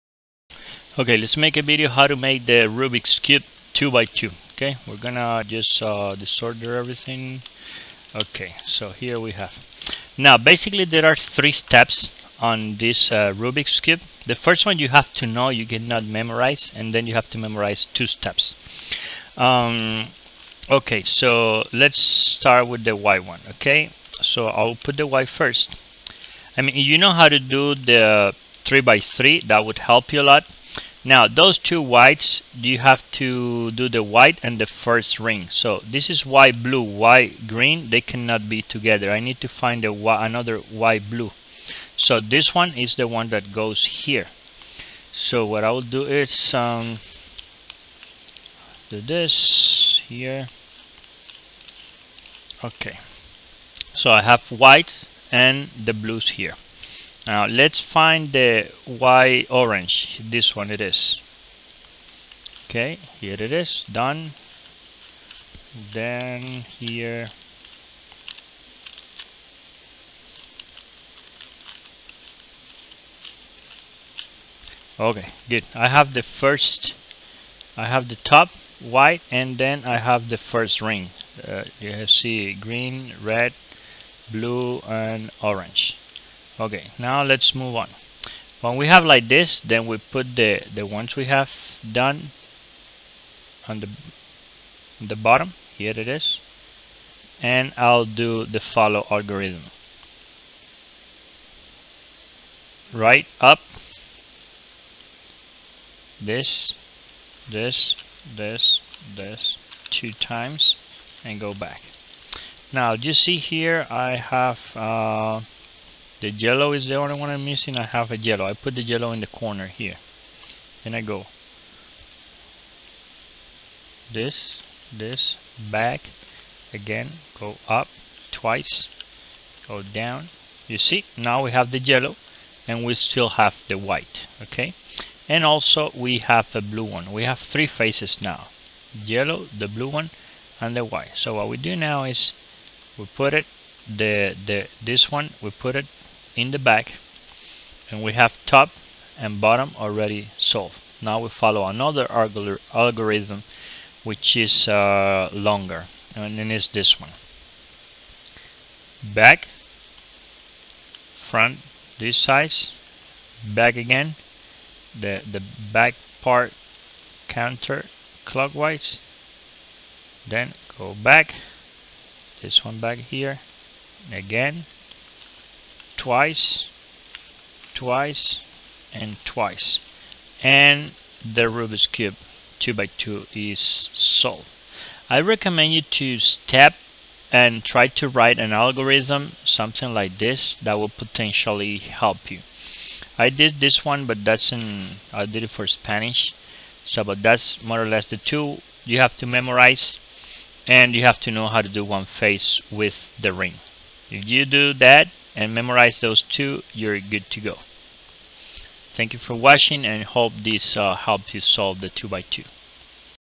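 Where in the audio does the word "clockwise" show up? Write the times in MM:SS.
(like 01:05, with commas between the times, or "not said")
02:48.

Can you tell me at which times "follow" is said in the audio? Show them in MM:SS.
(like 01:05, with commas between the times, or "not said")
01:38, 02:31.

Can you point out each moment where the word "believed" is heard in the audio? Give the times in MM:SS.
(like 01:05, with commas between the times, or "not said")
not said.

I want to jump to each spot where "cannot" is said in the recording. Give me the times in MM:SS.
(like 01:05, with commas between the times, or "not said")
00:15, 00:38.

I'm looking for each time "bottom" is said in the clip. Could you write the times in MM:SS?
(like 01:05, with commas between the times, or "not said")
01:35, 02:29.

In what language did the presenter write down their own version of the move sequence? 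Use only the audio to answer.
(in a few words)
Spanish.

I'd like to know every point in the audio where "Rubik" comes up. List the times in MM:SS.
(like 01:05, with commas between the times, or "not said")
00:02, 00:13, 03:01.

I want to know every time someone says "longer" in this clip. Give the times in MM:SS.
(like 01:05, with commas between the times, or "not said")
02:35.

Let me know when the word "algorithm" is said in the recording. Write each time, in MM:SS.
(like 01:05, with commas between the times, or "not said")
01:39, 02:32, 03:08.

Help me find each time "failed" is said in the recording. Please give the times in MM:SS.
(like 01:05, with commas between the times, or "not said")
not said.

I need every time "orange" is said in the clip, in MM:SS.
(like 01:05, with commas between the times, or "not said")
00:59, 01:25.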